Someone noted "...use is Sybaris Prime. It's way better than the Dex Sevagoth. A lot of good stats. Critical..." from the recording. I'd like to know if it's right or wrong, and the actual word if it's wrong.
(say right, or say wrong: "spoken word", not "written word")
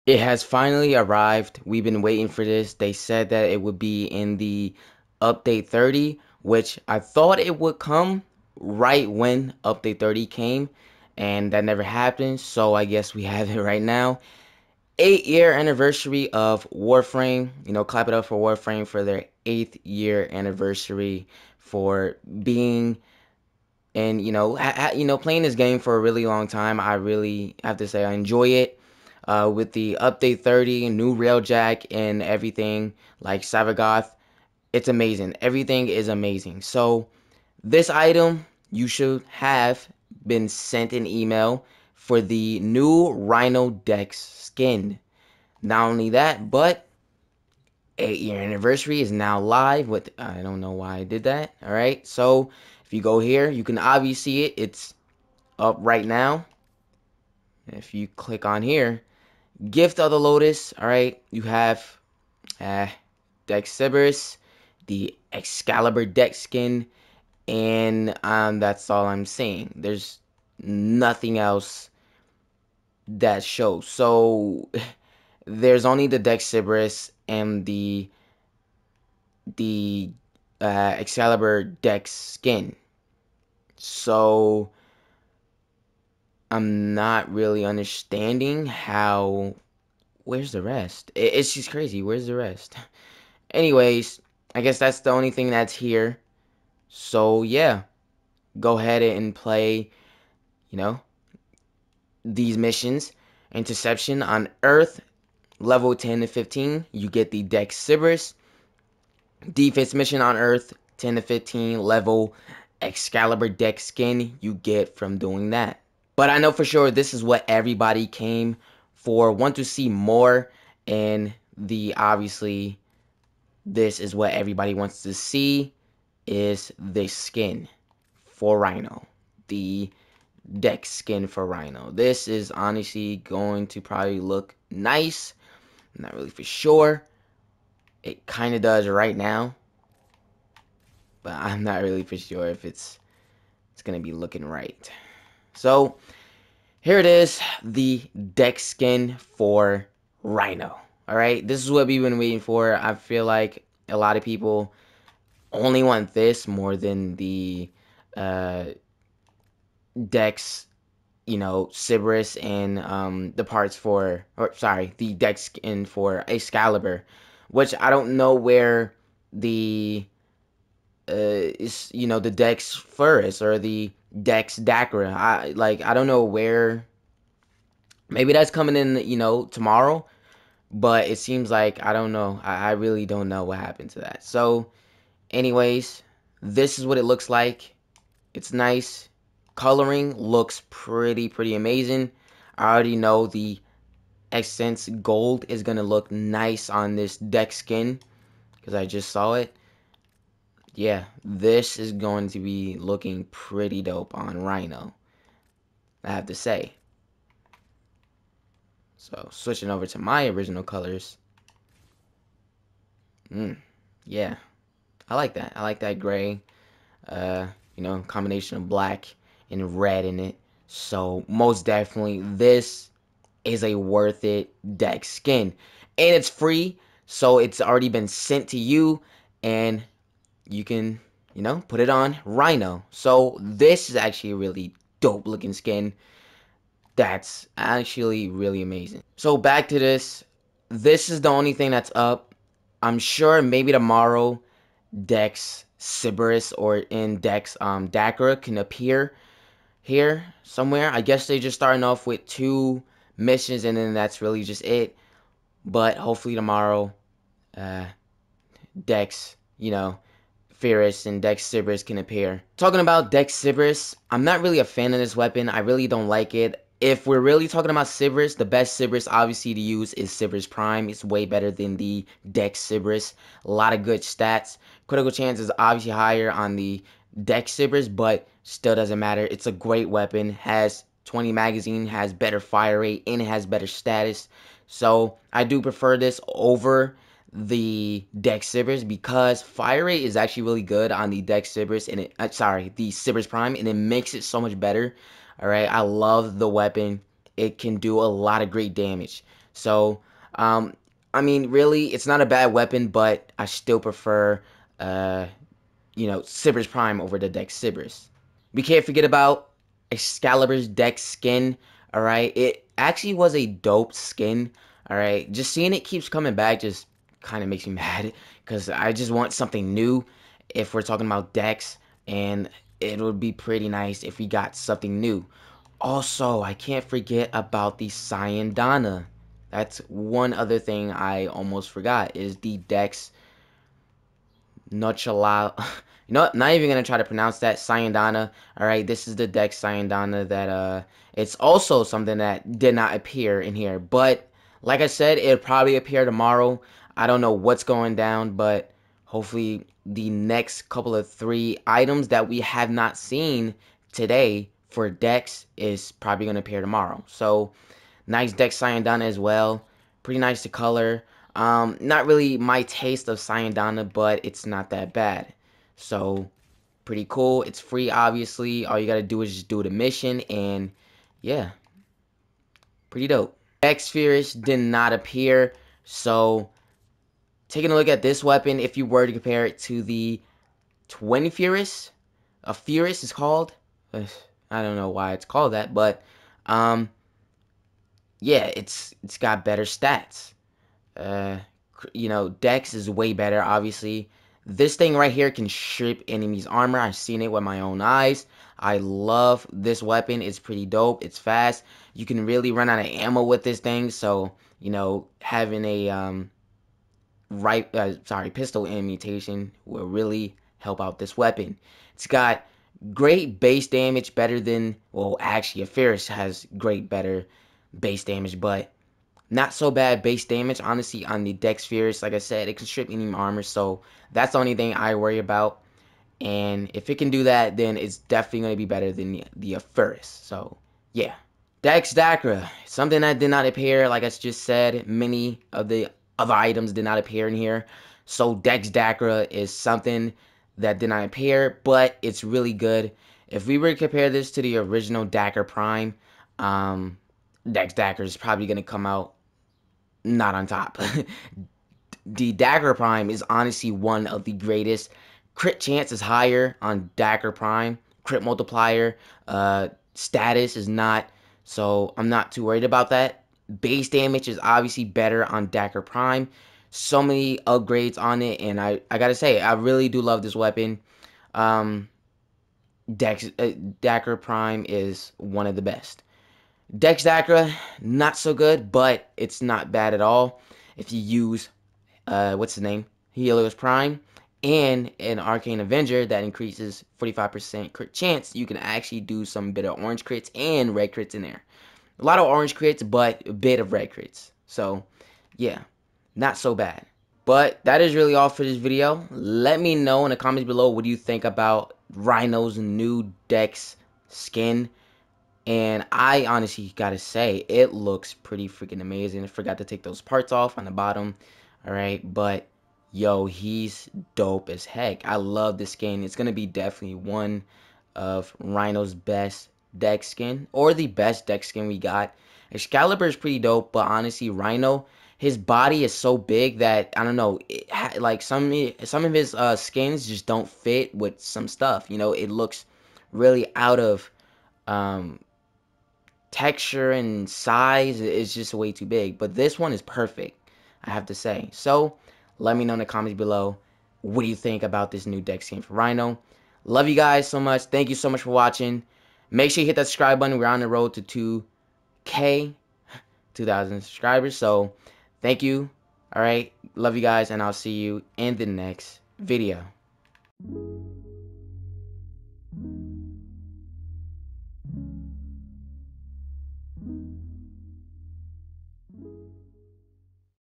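wrong: "Sybaris", not "Sevagoth".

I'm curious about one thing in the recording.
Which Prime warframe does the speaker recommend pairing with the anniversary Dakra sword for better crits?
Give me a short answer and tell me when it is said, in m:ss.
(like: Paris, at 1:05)
Helios Prime, at 8:03.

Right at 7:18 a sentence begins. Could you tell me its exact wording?
So Dex Dakra is something that did not appear, but it's really good.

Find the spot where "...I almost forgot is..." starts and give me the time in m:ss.
5:30.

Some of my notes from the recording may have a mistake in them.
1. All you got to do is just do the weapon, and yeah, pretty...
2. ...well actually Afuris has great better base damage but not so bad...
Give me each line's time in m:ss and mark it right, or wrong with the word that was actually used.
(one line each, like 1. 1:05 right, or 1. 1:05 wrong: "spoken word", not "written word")
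1. 6:08 wrong: "mission", not "weapon"
2. 6:54 right.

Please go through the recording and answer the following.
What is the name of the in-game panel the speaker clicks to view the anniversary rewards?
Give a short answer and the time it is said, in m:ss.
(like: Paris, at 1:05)
Gift of the Lotus, at 0:59.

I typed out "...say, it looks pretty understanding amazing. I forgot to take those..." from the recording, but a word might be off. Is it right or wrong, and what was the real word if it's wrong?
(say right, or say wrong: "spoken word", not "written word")
wrong: "freaking", not "understanding".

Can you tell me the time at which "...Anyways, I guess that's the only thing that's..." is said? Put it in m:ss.
1:33.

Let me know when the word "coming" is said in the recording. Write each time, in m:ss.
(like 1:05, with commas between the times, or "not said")
2:58, 5:16.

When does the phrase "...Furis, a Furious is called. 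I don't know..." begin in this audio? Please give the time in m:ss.
6:21.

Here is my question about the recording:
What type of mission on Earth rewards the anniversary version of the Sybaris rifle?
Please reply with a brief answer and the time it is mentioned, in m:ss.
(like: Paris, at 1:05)
Interception, at 1:43.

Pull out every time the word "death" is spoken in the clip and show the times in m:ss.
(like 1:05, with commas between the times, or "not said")
not said.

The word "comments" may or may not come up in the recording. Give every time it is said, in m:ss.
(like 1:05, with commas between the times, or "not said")
8:20, 9:02.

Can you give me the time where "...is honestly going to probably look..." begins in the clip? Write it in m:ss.
2:12.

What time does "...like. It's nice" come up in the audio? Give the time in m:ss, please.
3:07.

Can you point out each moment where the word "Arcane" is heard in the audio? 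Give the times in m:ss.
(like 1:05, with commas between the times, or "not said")
8:05.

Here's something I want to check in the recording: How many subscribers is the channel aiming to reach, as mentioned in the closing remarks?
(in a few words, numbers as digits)
2,000.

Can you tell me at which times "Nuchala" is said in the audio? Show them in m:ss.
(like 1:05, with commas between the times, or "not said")
5:34.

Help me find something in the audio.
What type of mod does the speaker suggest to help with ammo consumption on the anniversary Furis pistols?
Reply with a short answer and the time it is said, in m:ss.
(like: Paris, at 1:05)
Pistol mutation, at 6:48.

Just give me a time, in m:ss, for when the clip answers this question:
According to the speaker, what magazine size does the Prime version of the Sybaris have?
4:41.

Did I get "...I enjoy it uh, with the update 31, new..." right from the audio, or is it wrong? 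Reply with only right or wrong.
wrong.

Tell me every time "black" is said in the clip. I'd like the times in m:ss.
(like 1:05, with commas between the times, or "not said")
3:38.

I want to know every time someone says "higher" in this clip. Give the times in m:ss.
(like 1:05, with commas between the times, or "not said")
4:35, 7:36.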